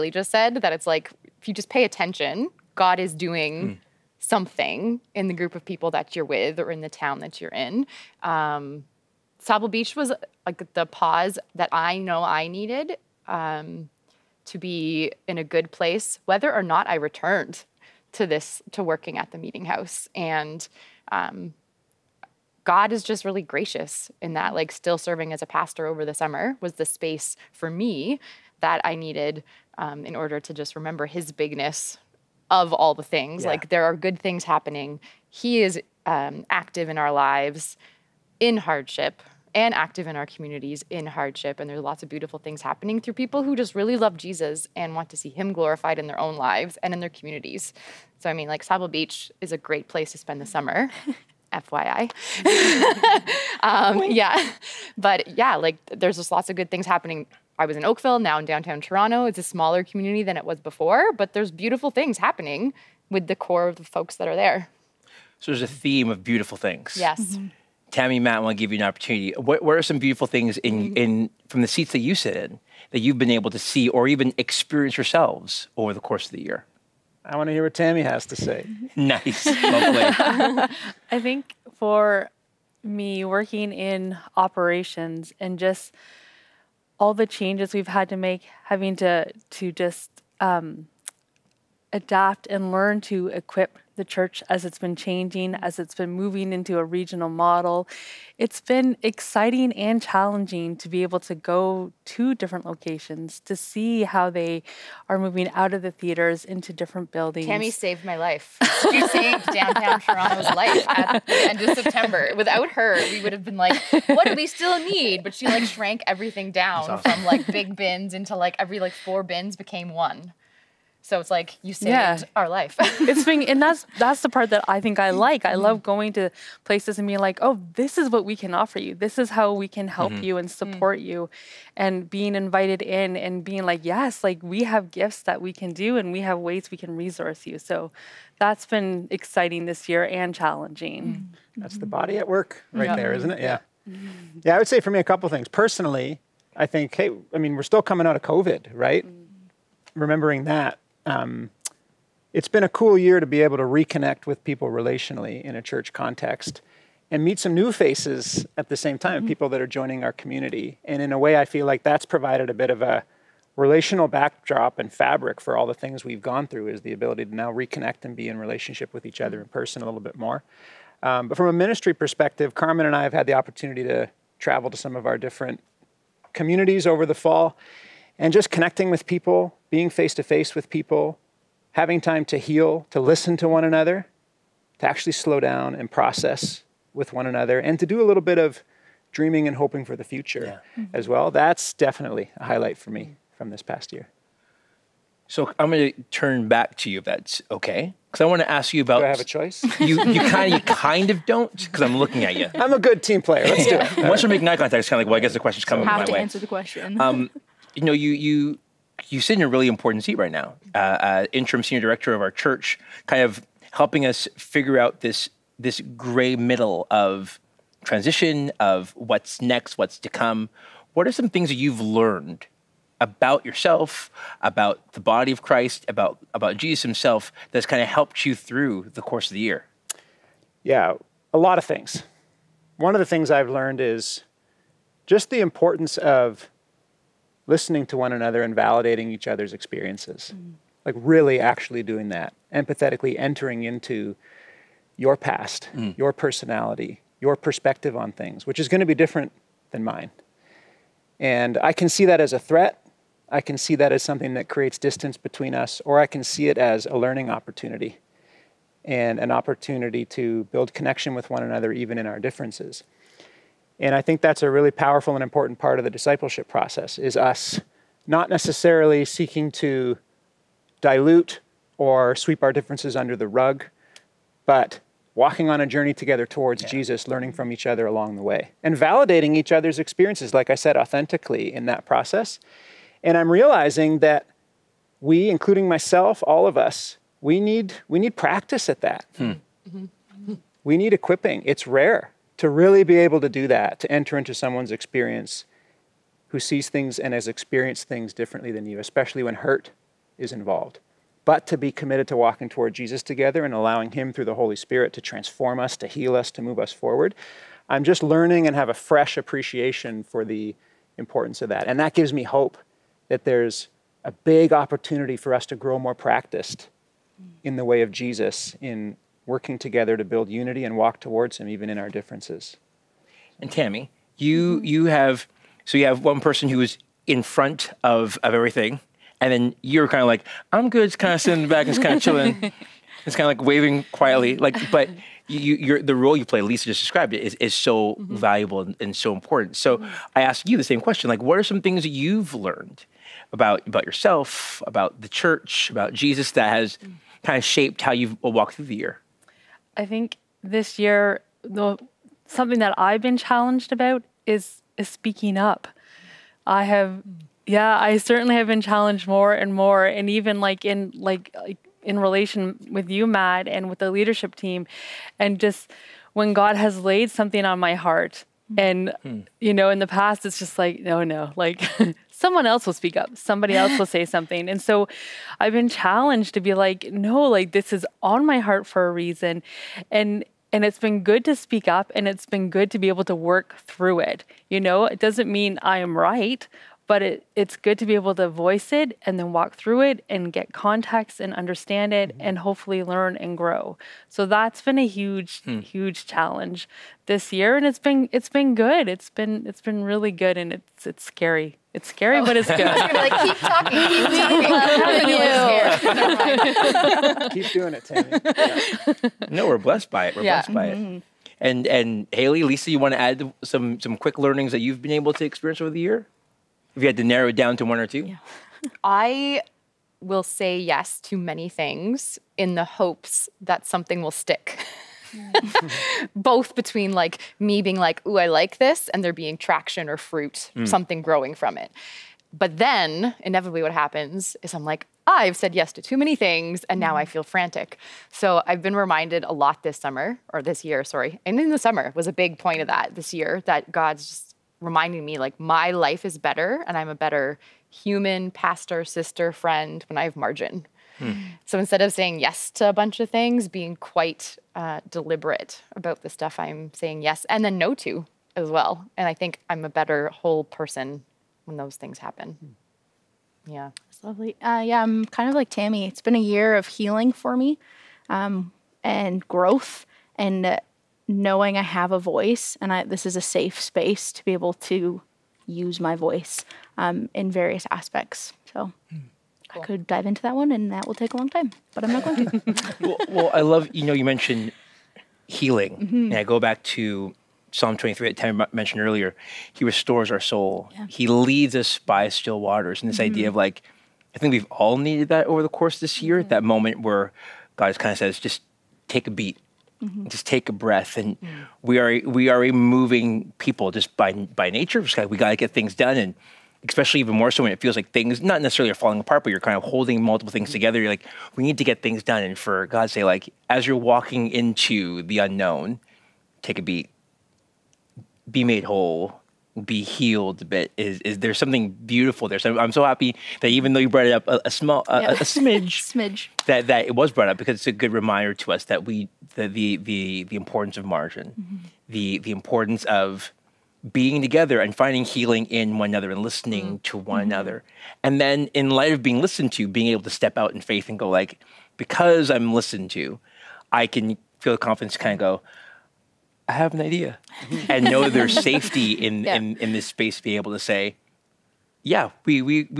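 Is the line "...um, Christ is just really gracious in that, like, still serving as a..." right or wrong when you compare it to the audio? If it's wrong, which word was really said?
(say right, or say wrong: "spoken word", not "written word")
wrong: "God", not "Christ".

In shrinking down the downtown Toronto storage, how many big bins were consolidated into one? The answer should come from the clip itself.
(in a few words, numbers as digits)
4.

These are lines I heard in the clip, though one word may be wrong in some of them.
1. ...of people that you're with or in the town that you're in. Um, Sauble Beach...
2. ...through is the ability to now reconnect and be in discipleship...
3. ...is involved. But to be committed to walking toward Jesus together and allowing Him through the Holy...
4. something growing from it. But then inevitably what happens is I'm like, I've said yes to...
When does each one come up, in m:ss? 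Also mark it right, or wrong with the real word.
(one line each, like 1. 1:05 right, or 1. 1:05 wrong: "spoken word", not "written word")
1. 0:05 right
2. 2:46 wrong: "relationship", not "discipleship"
3. 5:00 right
4. 7:10 right.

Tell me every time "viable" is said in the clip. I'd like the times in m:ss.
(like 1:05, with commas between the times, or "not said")
not said.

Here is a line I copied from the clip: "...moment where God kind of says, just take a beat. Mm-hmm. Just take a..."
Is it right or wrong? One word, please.
right.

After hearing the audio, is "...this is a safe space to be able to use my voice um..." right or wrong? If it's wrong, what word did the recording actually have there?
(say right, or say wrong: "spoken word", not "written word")
right.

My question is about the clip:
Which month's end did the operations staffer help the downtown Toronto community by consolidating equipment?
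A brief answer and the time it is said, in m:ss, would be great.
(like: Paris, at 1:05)
September, at 1:51.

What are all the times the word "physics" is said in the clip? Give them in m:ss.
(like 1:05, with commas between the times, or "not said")
not said.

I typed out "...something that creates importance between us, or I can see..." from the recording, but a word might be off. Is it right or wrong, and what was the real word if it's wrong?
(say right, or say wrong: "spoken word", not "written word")
wrong: "distance", not "importance".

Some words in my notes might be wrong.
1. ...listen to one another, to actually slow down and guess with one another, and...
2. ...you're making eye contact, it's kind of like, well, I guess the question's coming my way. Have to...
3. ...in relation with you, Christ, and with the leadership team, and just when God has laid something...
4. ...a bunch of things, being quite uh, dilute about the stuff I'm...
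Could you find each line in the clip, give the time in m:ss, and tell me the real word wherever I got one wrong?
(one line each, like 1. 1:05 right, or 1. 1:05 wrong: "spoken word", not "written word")
1. 3:02 wrong: "process", not "guess"
2. 3:24 right
3. 6:01 wrong: "Matt", not "Christ"
4. 7:32 wrong: "deliberate", not "dilute".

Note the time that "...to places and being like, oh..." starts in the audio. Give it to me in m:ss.
2:06.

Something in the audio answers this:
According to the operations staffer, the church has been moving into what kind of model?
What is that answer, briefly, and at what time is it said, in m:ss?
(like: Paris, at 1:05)
regional model, at 1:36.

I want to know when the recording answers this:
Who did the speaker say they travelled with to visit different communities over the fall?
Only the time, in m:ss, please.
2:52.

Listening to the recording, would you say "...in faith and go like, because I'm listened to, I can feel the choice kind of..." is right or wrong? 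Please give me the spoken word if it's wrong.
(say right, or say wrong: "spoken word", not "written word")
wrong: "confidence", not "choice".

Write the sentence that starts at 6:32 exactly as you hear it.
and hopefully learn and grow so that's been a huge hmm.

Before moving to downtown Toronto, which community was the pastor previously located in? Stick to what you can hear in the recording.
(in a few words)
Oakville.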